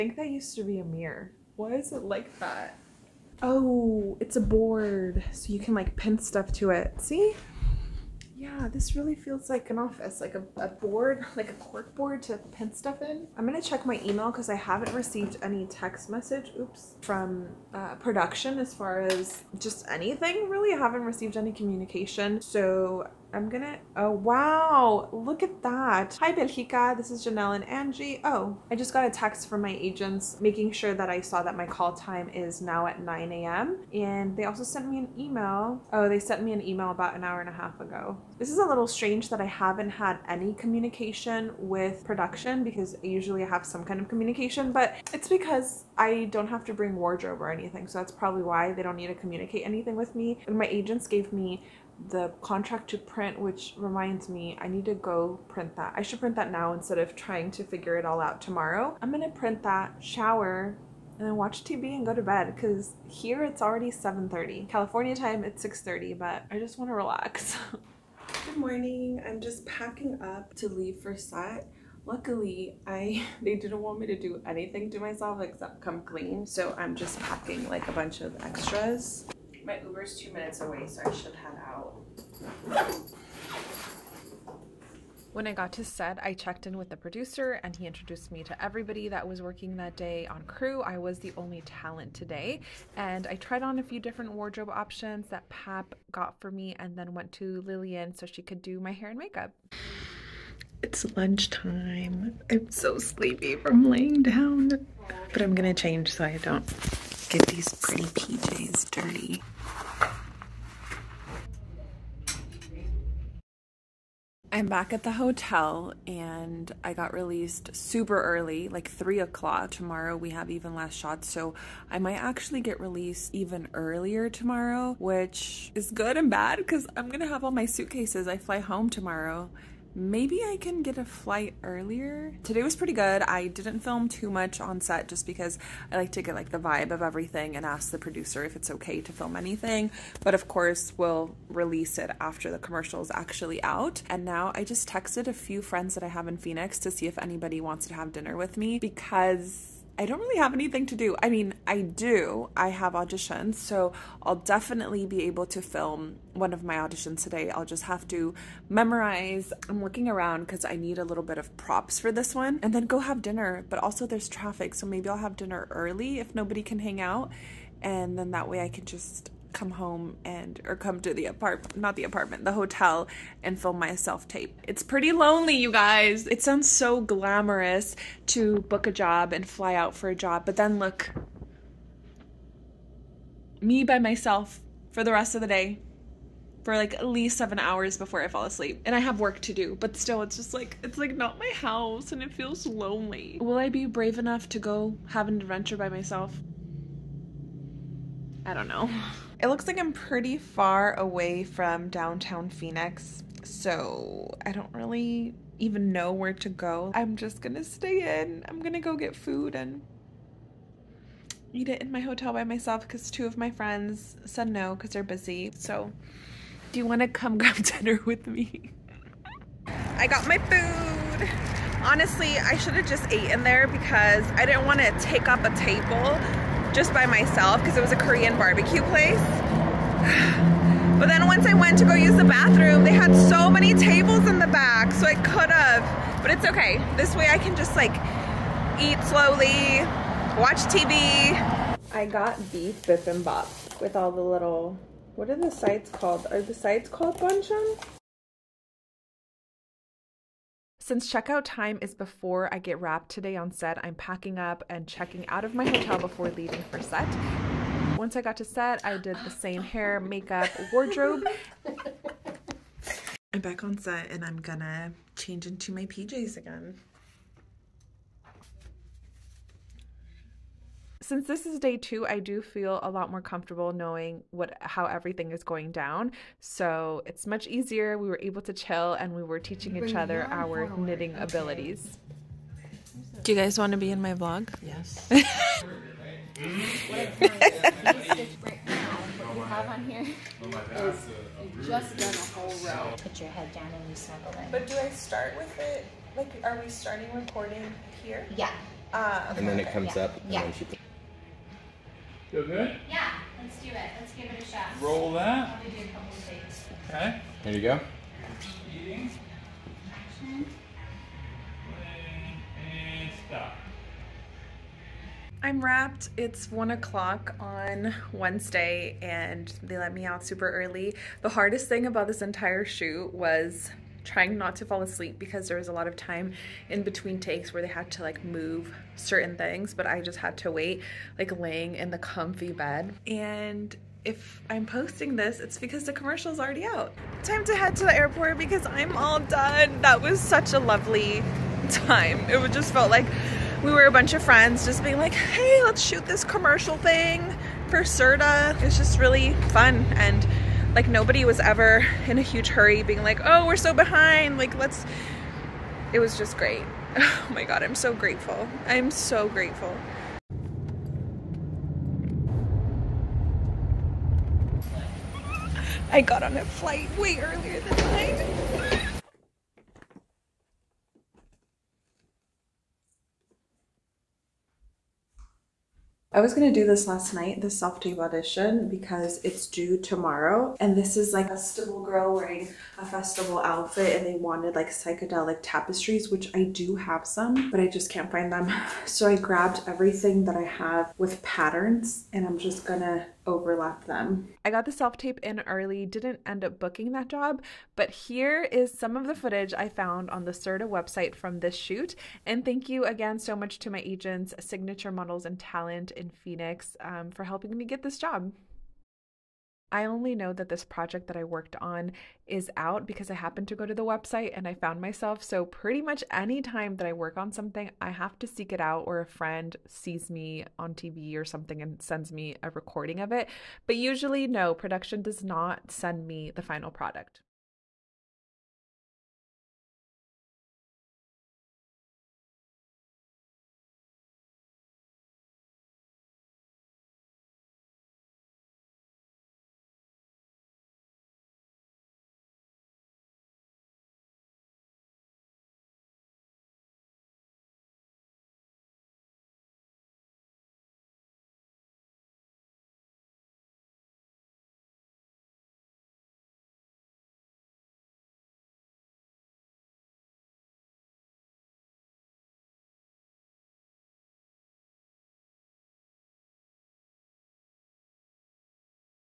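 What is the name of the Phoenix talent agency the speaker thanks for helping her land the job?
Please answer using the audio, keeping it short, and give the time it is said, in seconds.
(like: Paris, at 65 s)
Signature Models and Talent, at 404 s.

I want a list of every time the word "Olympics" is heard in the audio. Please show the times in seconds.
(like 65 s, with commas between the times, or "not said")
not said.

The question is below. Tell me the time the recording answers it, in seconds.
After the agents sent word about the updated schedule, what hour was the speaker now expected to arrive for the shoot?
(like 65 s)
33 s.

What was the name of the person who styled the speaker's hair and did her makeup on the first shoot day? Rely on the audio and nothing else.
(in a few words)
Lillian.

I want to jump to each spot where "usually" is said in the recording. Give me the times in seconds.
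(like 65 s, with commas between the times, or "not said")
43 s, 423 s.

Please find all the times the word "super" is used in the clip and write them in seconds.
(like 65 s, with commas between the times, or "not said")
117 s, 320 s.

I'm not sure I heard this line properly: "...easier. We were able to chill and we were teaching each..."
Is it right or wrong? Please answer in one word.
right.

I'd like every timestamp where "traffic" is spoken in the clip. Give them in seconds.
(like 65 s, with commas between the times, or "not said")
164 s.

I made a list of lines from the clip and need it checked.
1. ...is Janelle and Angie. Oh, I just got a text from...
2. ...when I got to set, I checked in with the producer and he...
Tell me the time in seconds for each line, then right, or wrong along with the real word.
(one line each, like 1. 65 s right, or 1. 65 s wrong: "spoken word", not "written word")
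1. 27 s right
2. 85 s right.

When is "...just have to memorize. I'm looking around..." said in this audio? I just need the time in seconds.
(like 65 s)
157 s.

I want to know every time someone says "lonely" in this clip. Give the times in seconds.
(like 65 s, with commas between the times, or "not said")
175 s, 192 s.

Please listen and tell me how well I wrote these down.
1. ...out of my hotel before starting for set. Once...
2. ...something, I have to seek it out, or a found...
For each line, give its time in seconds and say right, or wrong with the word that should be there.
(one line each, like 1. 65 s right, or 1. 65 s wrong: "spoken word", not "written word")
1. 255 s wrong: "leaving", not "starting"
2. 417 s wrong: "friend", not "found".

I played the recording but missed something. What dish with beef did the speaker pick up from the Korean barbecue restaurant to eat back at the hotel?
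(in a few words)
beef bibimbap.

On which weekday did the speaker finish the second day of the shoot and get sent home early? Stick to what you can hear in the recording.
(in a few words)
Wednesday.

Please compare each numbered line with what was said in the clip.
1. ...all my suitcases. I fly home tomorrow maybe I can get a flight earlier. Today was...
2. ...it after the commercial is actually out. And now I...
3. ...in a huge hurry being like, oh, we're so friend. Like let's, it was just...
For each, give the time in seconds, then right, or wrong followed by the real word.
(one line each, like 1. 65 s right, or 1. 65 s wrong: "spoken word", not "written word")
1. 127 s right
2. 141 s right
3. 352 s wrong: "behind", not "friend".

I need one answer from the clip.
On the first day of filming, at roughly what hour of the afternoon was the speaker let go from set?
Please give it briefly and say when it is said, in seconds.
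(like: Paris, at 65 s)
3 o'clock, at 118 s.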